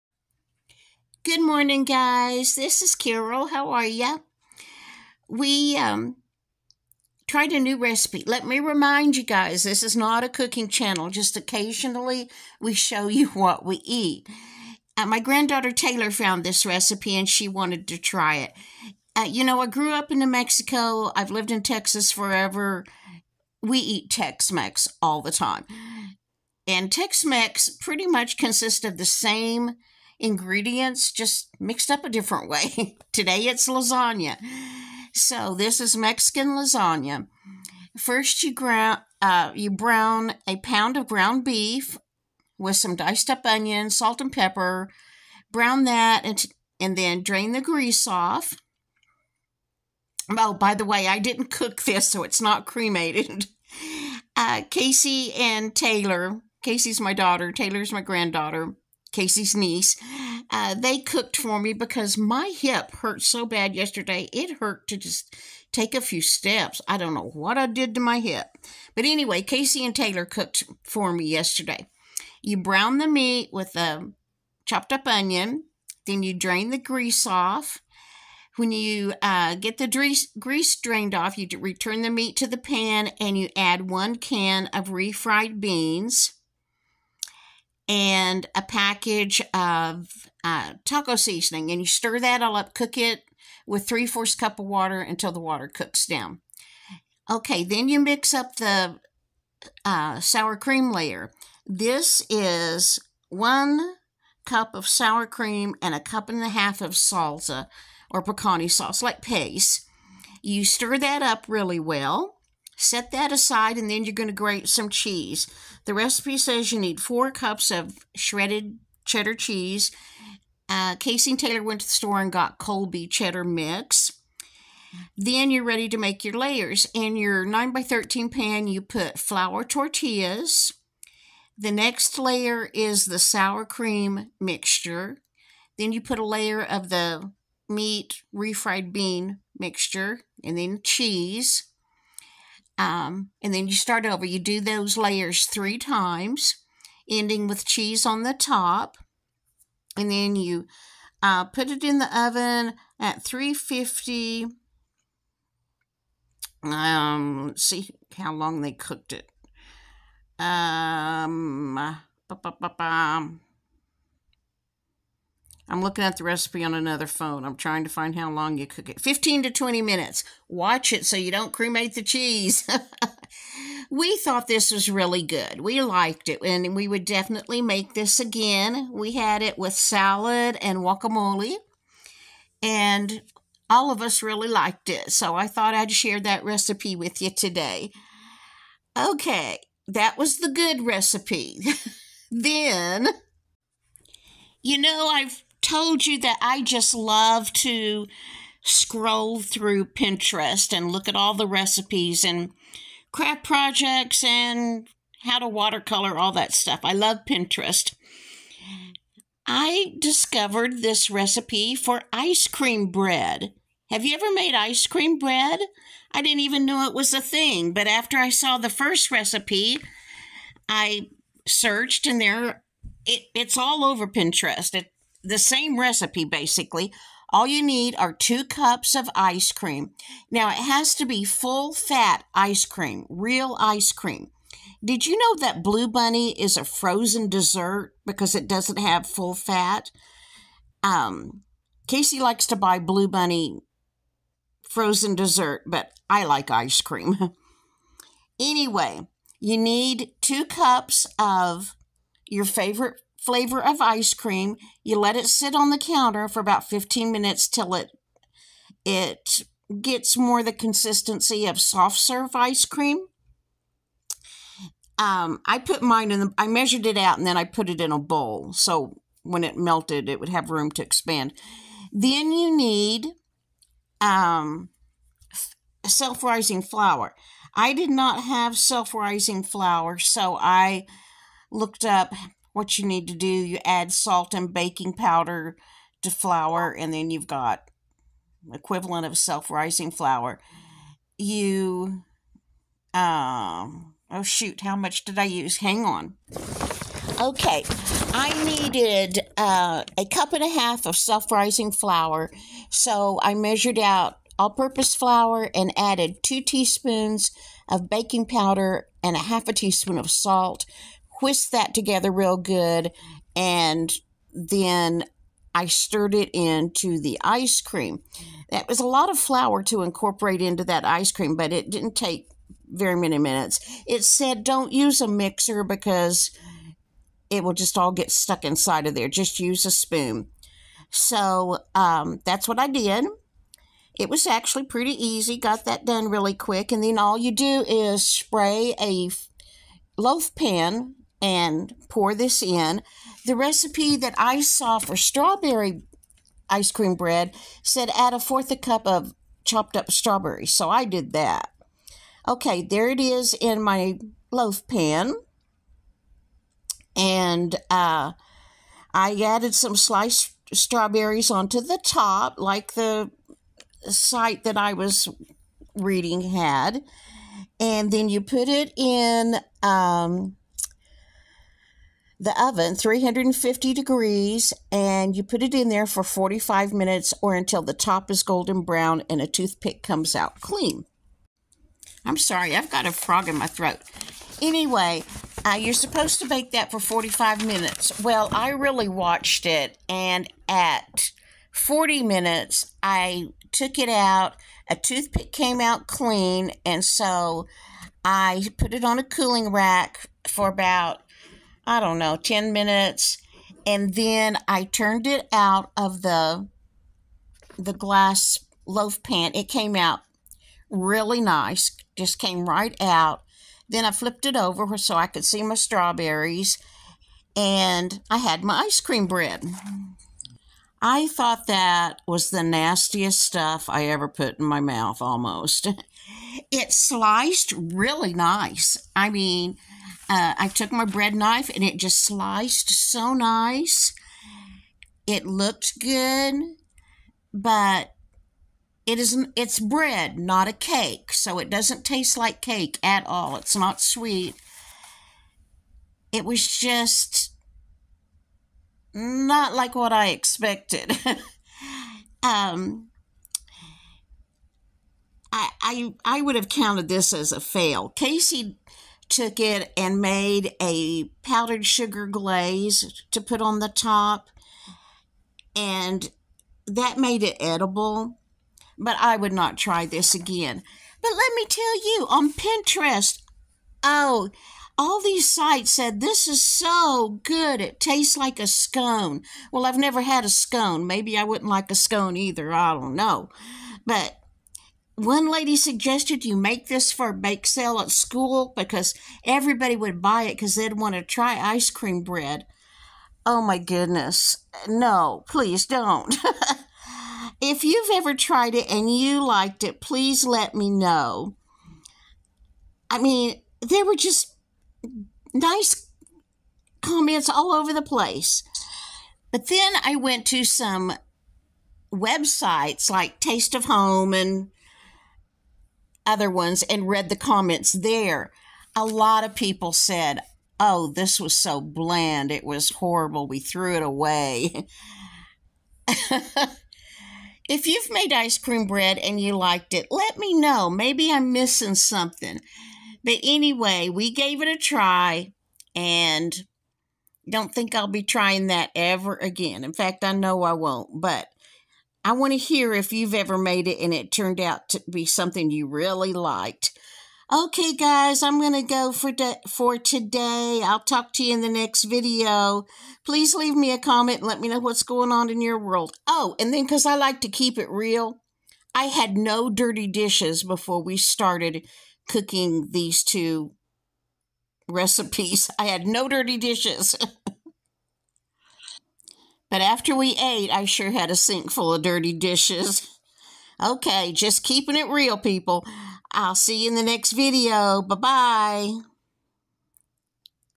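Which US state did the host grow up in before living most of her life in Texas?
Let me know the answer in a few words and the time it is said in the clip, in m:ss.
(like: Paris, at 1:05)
New Mexico, at 0:20.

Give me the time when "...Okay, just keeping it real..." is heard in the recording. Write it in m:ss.
9:33.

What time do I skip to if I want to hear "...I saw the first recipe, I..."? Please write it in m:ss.
3:38.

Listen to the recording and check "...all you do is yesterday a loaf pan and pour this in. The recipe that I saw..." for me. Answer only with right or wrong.
wrong.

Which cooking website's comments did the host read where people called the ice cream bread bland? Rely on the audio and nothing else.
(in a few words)
Taste of Home.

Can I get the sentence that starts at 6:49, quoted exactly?
It came out really nice, just came right out.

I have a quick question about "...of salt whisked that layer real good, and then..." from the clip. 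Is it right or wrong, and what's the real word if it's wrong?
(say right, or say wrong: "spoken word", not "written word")
wrong: "together", not "layer".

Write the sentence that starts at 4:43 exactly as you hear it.
You add salt and baking powder to flour, and then you've got equivalent of self-rising flour.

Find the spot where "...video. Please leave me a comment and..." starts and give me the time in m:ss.
9:11.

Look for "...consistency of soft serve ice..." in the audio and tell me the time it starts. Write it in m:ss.
4:20.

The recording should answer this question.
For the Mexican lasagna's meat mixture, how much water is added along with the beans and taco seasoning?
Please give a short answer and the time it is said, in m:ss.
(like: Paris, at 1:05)
3/4 cup, at 1:33.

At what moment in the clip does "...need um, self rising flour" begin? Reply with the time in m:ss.
4:32.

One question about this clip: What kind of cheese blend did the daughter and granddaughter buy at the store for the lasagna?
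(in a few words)
Colby cheddar mix.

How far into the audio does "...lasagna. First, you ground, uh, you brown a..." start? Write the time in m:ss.
0:36.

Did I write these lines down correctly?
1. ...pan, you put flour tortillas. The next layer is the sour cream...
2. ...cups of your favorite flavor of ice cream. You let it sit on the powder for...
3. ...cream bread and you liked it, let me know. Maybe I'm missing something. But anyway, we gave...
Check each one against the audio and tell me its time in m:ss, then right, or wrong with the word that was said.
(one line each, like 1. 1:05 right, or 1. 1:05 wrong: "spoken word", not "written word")
1. 2:08 right
2. 4:10 wrong: "counter", not "powder"
3. 8:48 right.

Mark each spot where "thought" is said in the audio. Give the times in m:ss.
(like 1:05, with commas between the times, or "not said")
2:54, 3:05, 7:01.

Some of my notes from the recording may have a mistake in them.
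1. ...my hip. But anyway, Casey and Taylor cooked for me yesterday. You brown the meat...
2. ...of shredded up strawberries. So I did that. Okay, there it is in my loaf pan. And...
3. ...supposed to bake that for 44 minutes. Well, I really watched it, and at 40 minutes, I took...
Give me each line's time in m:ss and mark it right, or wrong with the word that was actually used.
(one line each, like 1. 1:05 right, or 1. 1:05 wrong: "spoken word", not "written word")
1. 1:08 right
2. 5:48 wrong: "chopped", not "shredded"
3. 6:25 wrong: "45", not "44".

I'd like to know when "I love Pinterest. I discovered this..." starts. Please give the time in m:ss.
3:26.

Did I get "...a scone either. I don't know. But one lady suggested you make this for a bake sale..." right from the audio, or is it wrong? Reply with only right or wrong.
right.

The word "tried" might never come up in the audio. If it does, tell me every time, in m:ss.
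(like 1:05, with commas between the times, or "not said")
0:07, 8:18.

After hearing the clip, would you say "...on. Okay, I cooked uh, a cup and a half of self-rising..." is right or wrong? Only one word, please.
wrong.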